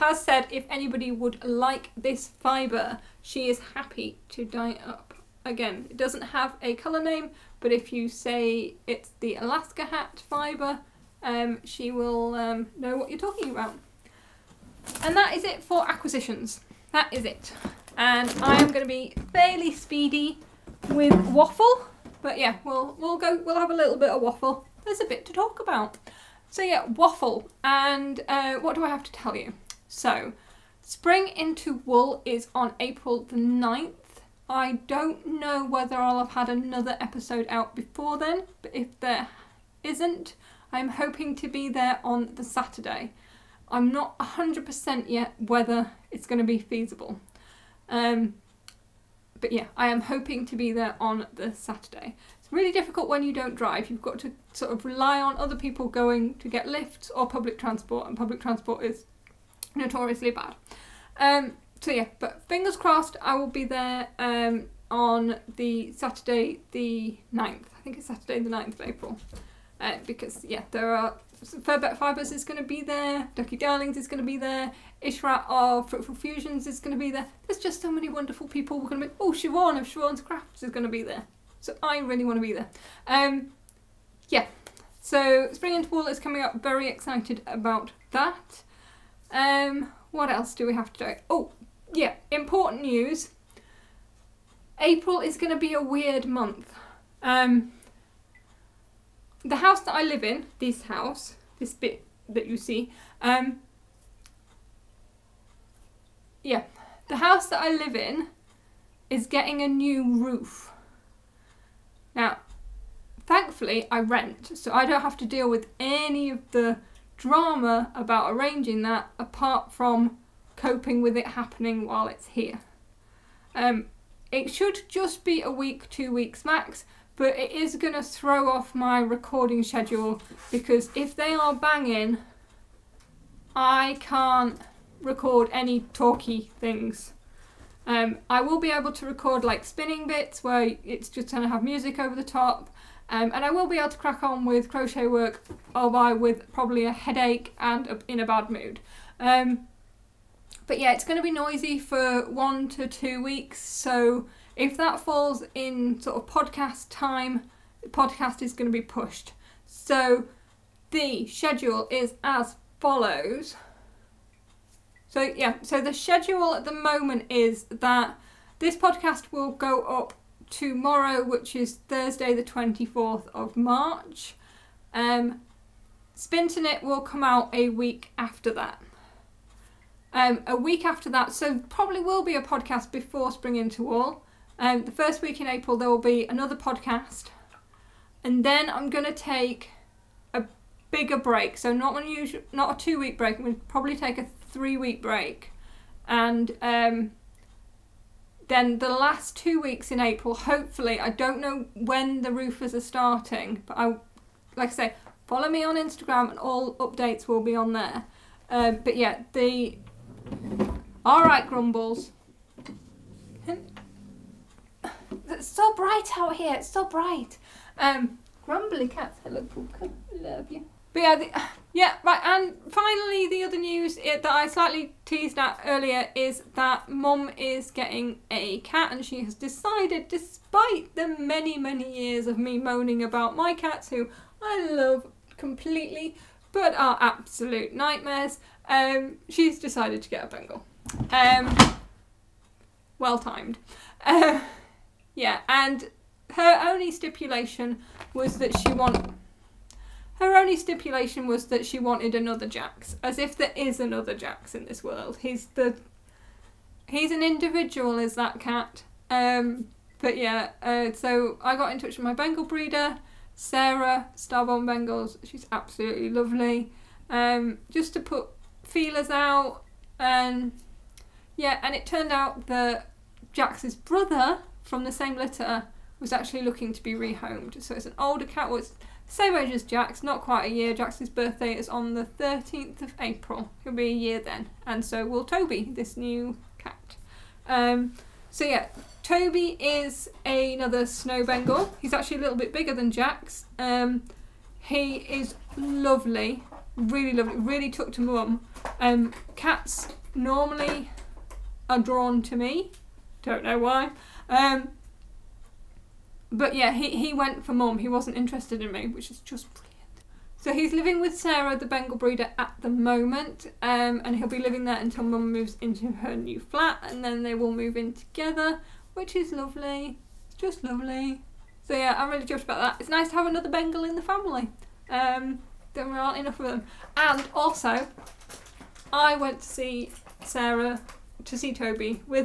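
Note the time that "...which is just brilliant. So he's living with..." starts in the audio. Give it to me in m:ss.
5:08.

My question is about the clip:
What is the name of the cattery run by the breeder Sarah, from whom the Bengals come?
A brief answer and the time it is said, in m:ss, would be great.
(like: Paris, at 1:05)
Starborn Bengals, at 4:24.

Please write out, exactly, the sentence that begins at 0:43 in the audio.
I'm not 100% yet whether it's going to be feasible.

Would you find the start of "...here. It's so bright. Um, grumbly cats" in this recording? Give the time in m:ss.
3:36.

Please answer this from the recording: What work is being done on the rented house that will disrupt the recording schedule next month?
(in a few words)
A new roof.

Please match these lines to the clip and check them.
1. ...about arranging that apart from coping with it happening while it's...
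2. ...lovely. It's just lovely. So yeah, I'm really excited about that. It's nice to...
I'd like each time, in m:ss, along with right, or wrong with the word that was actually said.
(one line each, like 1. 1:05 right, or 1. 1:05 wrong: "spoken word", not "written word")
1. 1:57 right
2. 5:19 wrong: "chuffed", not "excited".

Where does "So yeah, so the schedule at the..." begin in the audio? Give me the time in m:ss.
2:45.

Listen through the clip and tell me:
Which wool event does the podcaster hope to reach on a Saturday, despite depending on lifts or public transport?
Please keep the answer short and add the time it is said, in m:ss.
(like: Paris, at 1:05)
Spring into Wool, at 0:30.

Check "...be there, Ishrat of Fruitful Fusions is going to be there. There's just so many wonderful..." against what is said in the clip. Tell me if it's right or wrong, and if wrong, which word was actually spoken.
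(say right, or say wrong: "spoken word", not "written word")
right.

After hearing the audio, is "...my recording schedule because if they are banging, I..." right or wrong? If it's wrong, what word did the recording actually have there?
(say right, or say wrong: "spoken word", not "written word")
right.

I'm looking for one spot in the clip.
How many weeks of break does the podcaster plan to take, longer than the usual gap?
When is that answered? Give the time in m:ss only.
3:14.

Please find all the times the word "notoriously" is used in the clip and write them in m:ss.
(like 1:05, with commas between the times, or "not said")
0:59.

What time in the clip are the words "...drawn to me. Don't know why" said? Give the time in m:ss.
5:01.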